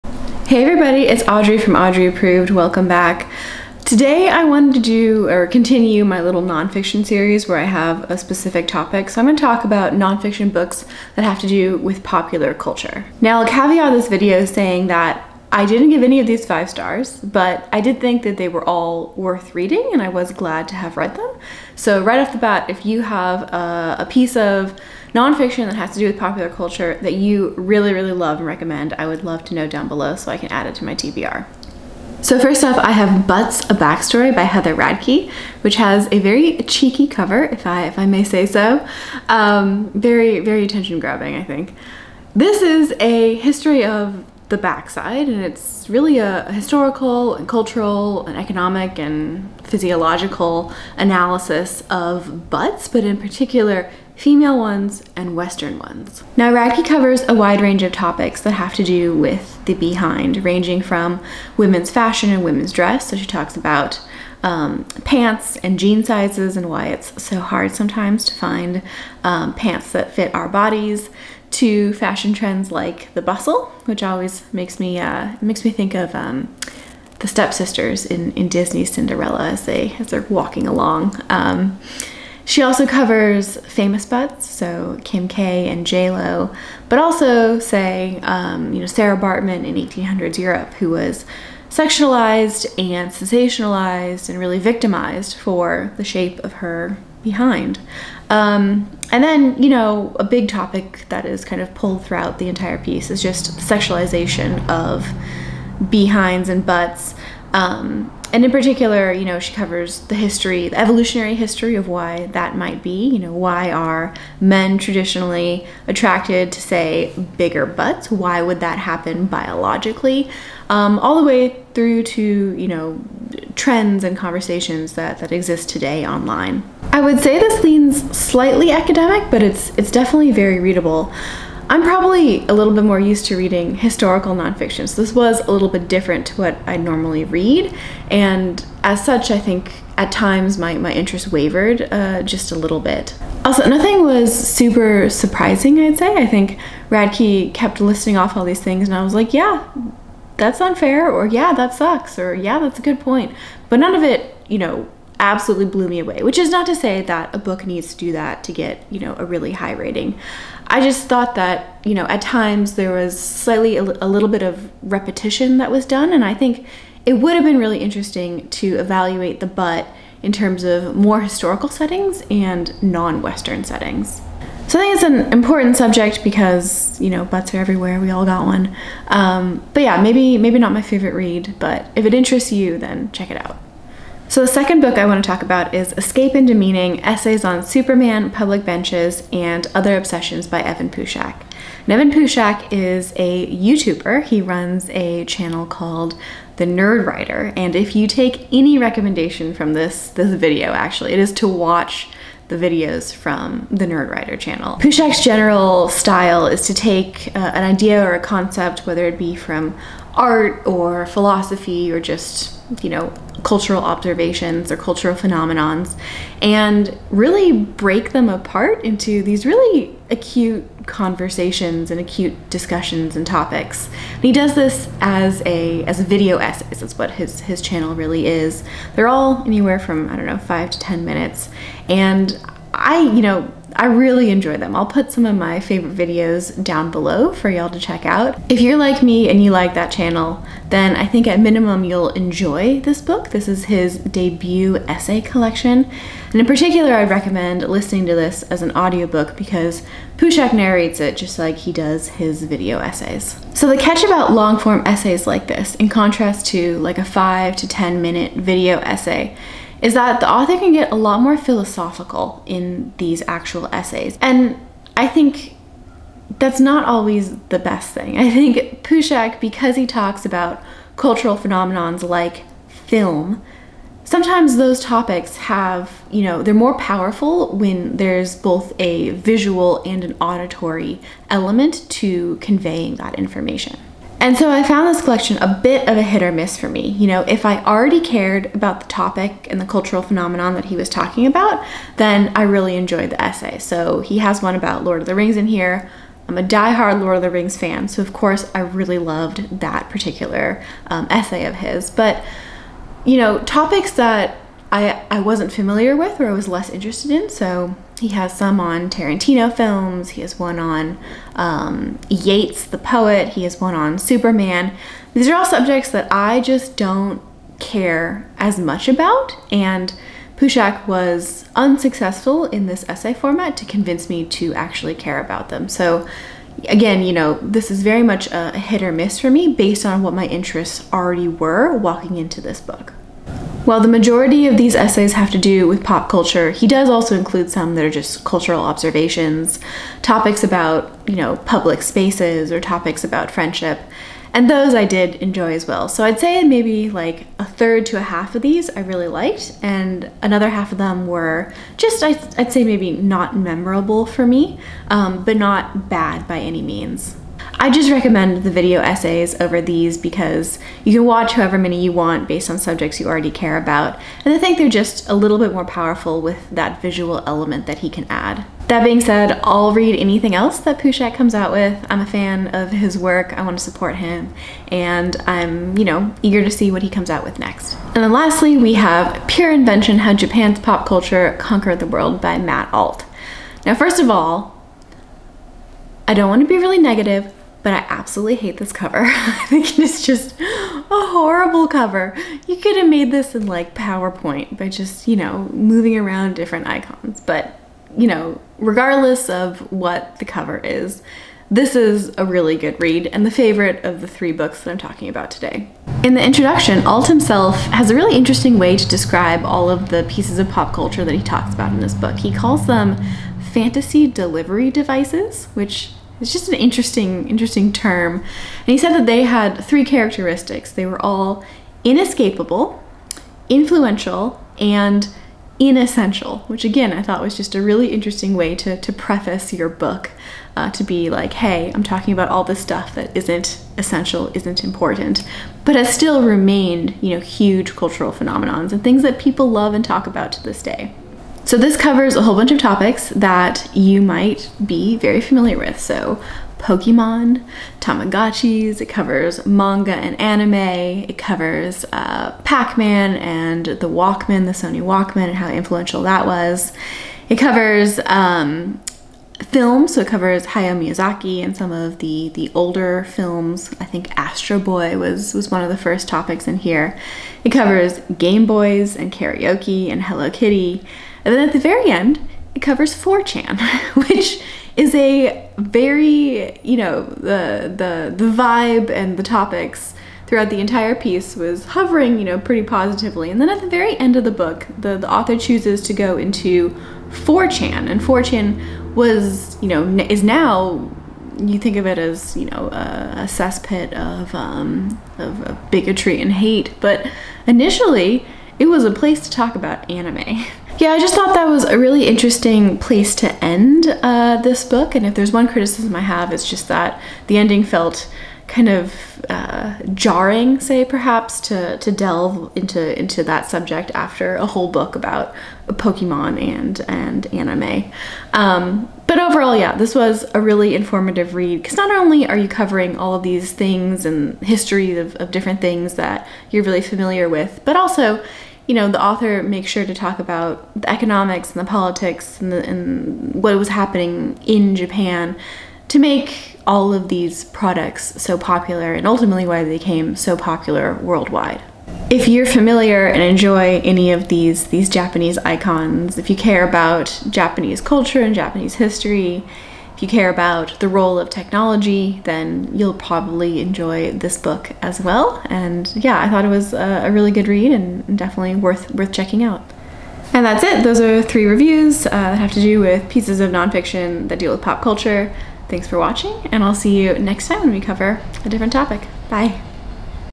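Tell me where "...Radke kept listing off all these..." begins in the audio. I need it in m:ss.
2:26.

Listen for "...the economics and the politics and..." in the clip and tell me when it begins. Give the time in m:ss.
8:50.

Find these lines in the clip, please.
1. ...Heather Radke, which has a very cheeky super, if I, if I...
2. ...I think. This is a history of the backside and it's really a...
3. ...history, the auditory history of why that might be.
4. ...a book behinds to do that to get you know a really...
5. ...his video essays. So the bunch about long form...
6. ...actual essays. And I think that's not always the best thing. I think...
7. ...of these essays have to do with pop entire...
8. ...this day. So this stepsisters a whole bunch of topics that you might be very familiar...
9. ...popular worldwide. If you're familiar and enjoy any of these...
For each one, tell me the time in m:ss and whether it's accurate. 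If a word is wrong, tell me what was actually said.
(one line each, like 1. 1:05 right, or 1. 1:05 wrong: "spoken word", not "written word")
1. 0:34 wrong: "cover", not "super"
2. 0:41 right
3. 1:50 wrong: "evolutionary", not "auditory"
4. 2:37 wrong: "needs", not "behinds"
5. 4:12 wrong: "catch", not "bunch"
6. 4:23 right
7. 5:34 wrong: "culture", not "entire"
8. 7:20 wrong: "covers", not "stepsisters"
9. 9:00 right.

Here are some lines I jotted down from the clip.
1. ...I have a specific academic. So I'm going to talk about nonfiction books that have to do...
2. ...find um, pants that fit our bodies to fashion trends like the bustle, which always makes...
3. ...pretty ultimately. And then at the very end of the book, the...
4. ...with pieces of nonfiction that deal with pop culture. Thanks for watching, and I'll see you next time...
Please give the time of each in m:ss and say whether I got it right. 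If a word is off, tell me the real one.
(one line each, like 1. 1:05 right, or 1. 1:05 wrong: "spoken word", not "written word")
1. 0:07 wrong: "topic", not "academic"
2. 1:08 right
3. 8:02 wrong: "positively", not "ultimately"
4. 9:22 right.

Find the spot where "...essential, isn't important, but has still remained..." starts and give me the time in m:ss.
7:13.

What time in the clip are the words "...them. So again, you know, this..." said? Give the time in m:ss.
5:25.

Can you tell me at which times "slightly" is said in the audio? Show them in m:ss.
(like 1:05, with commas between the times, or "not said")
2:08, 2:43.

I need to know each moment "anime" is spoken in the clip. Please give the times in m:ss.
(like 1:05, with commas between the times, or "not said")
7:30, 8:19, 8:37.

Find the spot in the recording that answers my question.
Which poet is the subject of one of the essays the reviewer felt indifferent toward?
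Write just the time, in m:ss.
5:12.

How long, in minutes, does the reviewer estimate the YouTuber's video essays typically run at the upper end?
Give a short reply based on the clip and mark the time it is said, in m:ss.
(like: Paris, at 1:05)
10, at 3:50.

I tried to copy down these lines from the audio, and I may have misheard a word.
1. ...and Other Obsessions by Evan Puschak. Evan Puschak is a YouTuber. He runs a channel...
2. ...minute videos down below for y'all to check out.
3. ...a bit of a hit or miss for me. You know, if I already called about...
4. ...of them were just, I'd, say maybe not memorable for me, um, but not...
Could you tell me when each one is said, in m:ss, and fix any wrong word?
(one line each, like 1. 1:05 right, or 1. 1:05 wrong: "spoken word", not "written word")
1. 3:09 right
2. 3:55 wrong: "favorite", not "minute"
3. 4:45 wrong: "cared", not "called"
4. 5:50 right.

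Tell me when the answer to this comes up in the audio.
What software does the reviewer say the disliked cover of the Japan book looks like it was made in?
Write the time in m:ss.
6:33.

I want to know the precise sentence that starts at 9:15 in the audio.
And yeah, I thought it was a, a really good read and definitely worth worth checking out.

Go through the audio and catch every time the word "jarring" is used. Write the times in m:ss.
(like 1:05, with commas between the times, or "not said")
8:29.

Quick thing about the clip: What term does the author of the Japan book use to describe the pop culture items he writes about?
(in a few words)
fantasy delivery devices.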